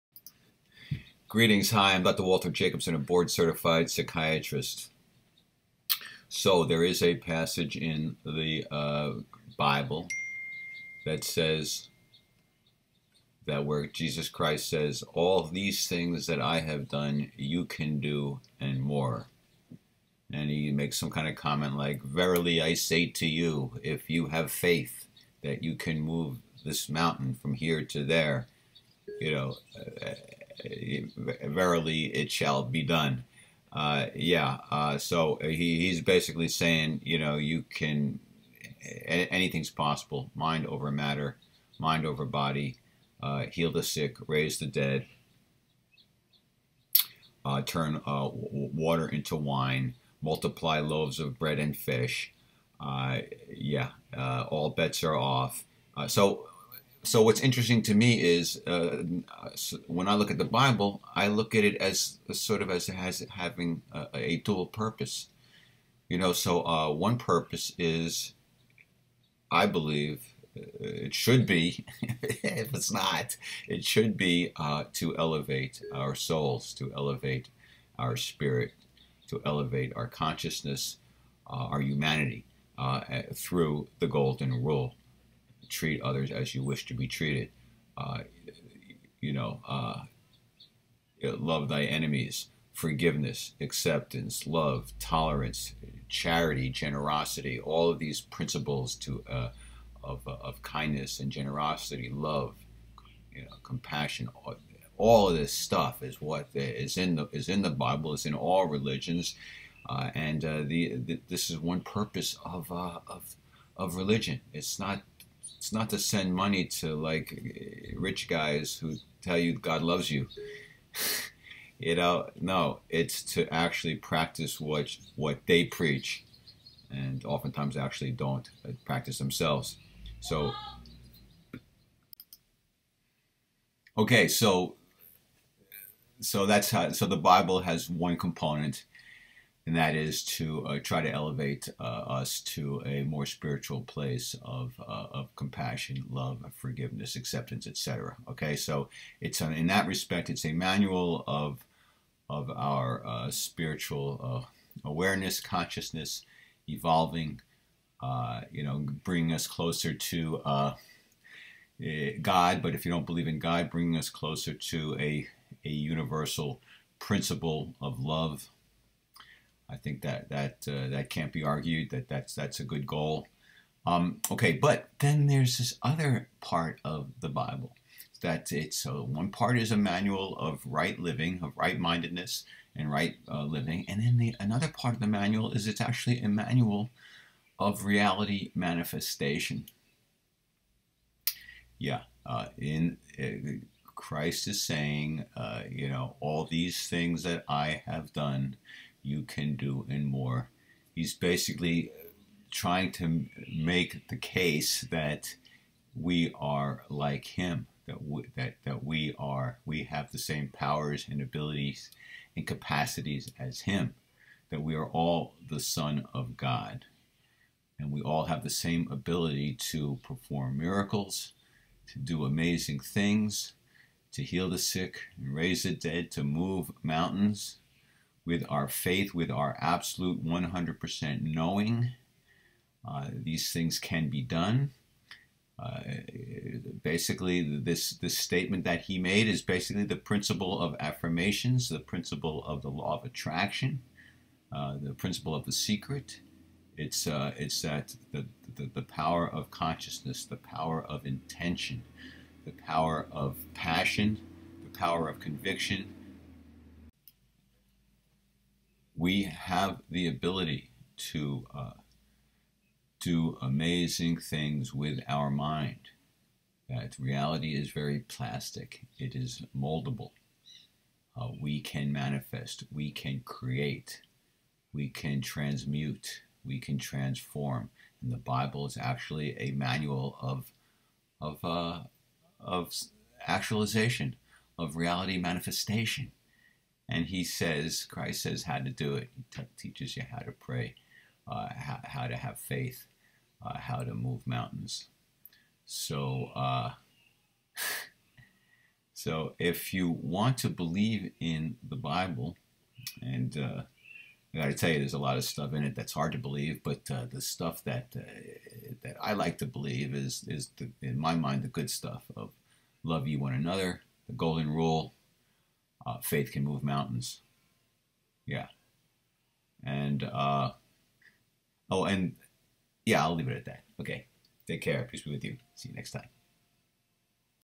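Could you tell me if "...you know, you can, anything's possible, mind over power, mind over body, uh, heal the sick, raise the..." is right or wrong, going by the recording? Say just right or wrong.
wrong.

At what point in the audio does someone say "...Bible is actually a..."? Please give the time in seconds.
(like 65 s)
278 s.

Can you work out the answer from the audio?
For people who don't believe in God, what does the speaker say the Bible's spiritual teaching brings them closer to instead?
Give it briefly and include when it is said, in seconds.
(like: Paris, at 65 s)
universal principle of love, at 165 s.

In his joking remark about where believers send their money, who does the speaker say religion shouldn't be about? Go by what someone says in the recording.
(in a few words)
rich guys.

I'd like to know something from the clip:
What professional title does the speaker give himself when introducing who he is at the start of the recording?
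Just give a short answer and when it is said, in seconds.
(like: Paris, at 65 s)
board certified psychiatrist, at 2 s.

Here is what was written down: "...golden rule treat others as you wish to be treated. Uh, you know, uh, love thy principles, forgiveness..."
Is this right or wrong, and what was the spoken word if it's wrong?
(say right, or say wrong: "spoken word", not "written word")
wrong: "enemies", not "principles".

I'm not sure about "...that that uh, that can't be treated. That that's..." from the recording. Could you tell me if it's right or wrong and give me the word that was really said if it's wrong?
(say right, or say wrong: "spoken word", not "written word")
wrong: "argued", not "treated".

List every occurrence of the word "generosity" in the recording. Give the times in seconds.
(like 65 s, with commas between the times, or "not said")
96 s, 101 s.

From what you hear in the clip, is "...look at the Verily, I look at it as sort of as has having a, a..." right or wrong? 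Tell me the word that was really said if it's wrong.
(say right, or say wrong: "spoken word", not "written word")
wrong: "Bible", not "Verily".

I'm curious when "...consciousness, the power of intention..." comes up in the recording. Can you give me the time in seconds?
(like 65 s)
249 s.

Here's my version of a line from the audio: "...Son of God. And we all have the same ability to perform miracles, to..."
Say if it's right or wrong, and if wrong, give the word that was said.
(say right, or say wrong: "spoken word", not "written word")
right.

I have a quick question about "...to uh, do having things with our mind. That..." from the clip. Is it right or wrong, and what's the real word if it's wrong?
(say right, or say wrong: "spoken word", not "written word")
wrong: "amazing", not "having".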